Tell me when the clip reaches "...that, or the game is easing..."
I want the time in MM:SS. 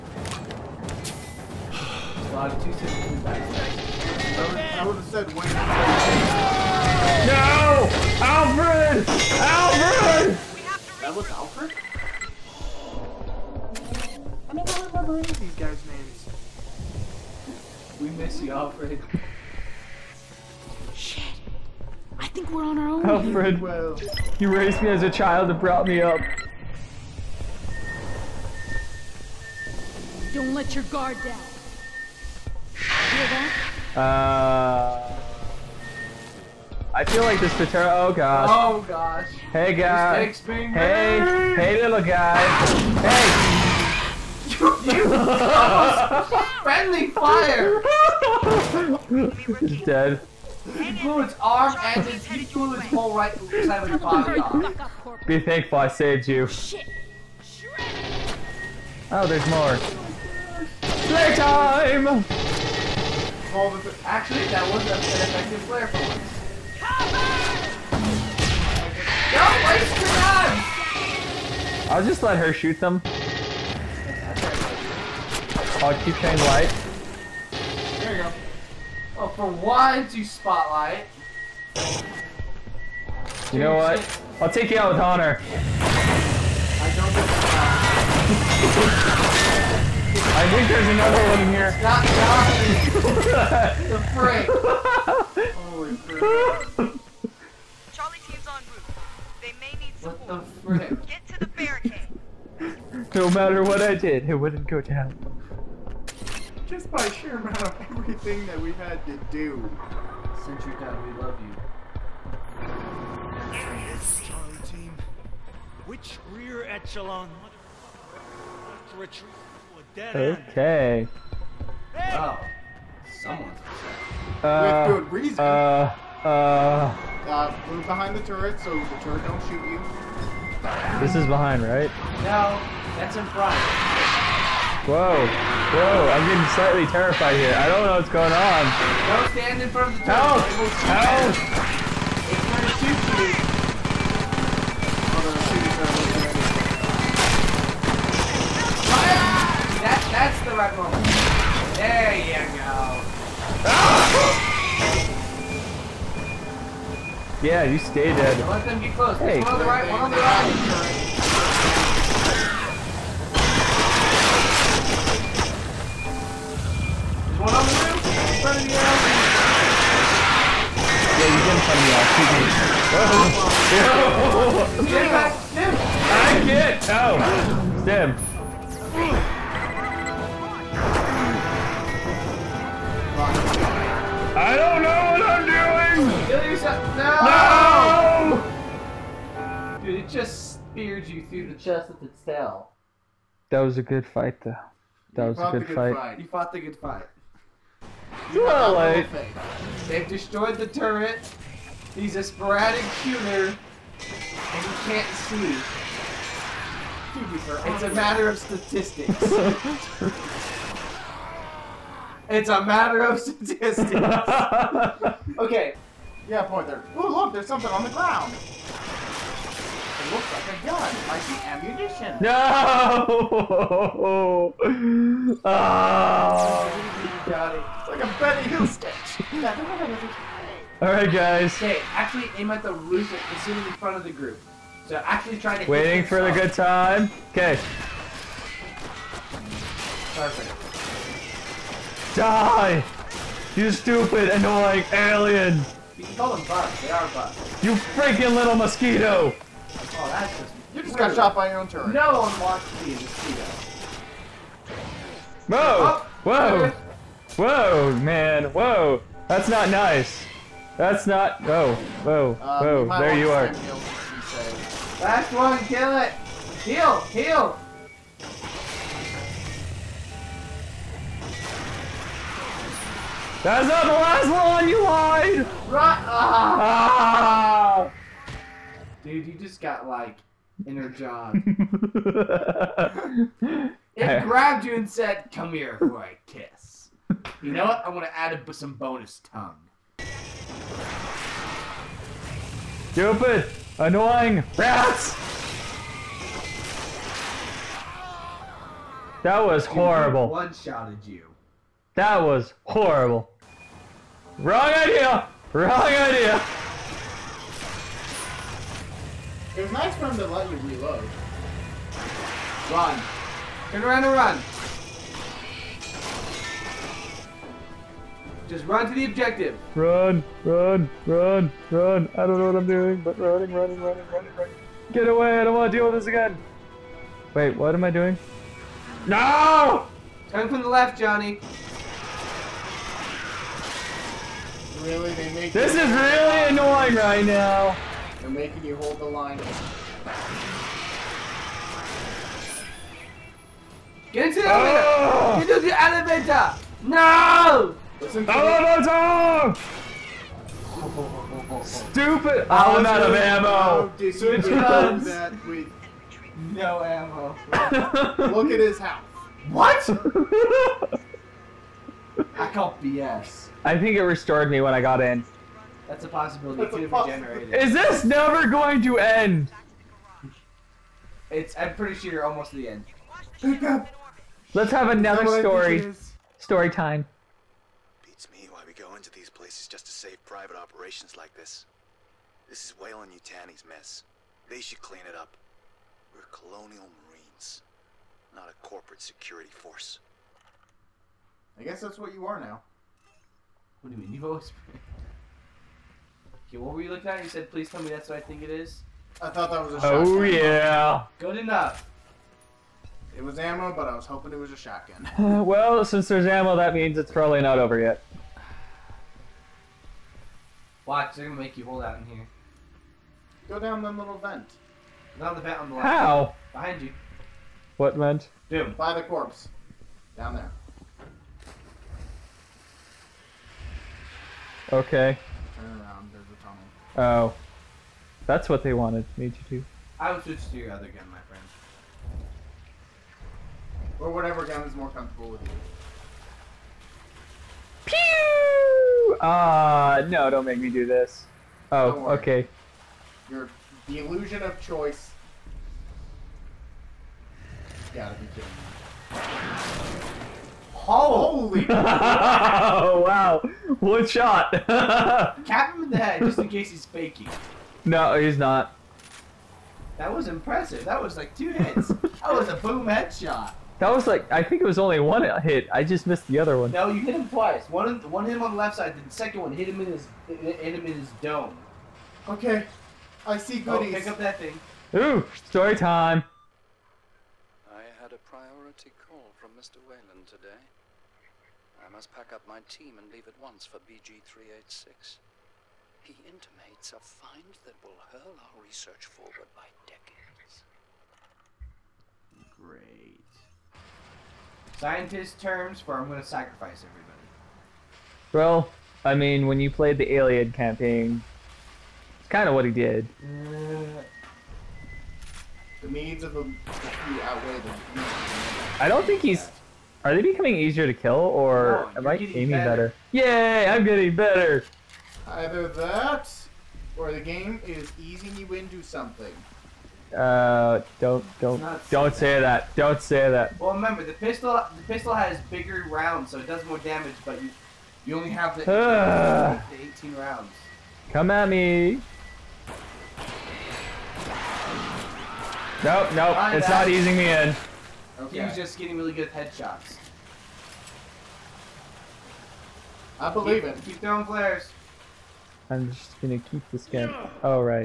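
08:35.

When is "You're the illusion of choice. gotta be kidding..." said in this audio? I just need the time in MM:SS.
07:23.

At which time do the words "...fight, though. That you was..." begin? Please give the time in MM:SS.
03:14.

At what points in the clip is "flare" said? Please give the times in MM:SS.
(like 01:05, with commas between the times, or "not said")
01:05, 09:04.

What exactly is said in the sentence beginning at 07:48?
The second one hit him in his hit him in his dome.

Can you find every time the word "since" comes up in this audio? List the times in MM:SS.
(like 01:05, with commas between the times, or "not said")
01:50, 06:45.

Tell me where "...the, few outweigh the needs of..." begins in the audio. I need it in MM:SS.
08:26.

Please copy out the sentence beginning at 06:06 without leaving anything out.
That's Is this never going to end?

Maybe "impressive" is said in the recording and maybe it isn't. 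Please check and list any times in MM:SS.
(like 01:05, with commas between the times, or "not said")
07:40.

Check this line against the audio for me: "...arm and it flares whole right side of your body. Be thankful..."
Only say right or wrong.
wrong.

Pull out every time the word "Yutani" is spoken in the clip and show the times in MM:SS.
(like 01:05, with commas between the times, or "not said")
06:22.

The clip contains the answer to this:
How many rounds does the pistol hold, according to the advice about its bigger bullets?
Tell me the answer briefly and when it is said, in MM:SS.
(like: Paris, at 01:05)
18, at 08:49.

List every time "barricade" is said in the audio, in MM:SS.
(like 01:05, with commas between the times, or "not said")
01:41.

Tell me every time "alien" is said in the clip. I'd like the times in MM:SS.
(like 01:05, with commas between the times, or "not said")
04:04, 08:20.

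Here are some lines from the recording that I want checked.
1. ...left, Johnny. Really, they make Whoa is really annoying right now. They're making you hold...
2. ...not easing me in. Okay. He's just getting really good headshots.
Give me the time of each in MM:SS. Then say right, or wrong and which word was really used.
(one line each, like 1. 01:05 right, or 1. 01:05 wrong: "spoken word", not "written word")
1. 05:30 wrong: "This", not "Whoa"
2. 08:56 right.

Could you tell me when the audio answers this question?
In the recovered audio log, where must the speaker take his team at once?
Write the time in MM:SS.
08:03.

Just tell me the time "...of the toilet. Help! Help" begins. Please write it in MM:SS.
02:19.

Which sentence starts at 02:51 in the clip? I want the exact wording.
Yeah, you get in front of the alley.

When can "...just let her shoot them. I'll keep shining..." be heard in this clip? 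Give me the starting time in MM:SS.
01:12.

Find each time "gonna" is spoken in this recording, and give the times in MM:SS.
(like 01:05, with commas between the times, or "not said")
06:51, 08:16, 09:06.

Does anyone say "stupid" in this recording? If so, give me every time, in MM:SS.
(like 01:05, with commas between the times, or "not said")
04:03, 04:52, 05:51.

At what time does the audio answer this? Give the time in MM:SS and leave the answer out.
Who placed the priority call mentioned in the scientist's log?
07:59.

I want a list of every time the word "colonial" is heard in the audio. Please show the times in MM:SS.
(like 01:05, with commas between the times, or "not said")
06:26.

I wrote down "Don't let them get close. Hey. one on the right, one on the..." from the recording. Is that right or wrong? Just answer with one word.
right.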